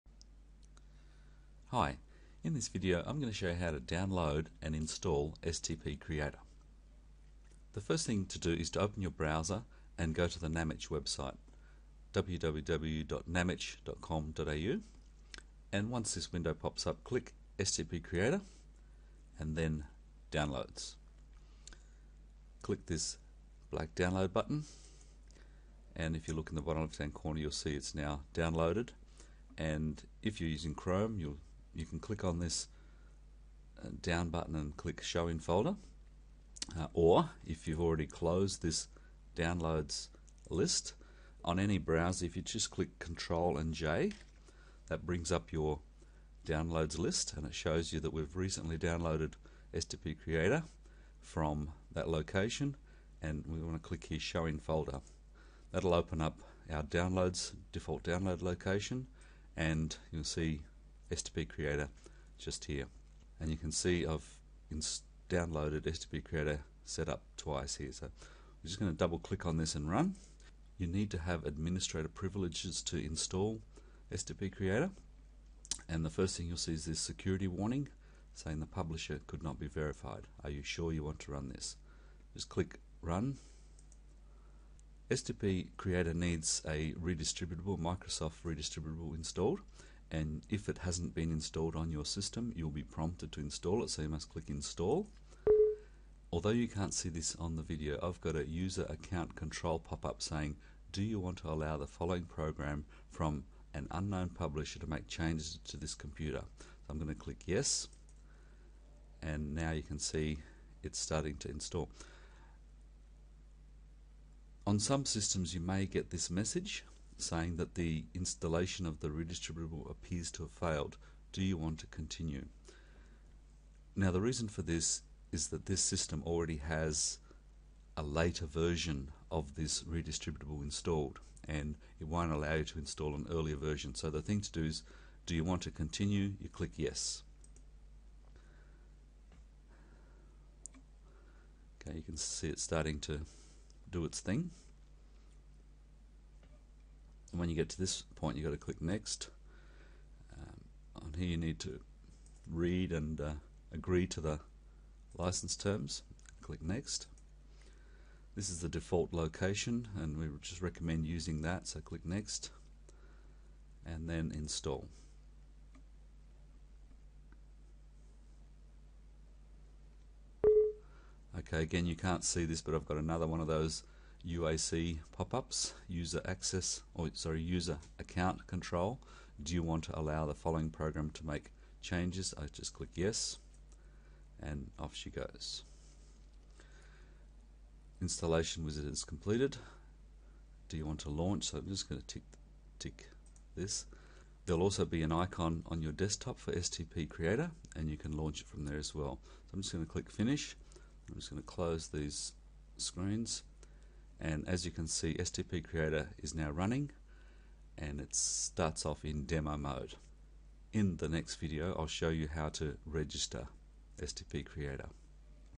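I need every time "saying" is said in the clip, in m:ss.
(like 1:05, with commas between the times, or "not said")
1:18, 1:40, 1:57.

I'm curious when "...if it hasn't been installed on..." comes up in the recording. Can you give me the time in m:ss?
1:30.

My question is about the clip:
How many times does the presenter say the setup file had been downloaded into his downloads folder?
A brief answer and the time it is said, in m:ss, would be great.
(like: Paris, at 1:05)
Twice, at 1:07.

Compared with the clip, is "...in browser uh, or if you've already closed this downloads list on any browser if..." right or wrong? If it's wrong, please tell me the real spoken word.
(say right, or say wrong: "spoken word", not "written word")
wrong: "folder", not "browser".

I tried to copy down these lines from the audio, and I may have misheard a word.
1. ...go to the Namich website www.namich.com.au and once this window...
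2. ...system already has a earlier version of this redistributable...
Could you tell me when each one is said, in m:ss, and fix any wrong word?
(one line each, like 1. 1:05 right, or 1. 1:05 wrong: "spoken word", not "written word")
1. 0:10 right
2. 2:05 wrong: "later", not "earlier".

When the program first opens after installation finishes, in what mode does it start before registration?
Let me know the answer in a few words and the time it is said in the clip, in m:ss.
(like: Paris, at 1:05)
Demo mode, at 3:29.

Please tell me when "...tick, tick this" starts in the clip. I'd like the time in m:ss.
3:12.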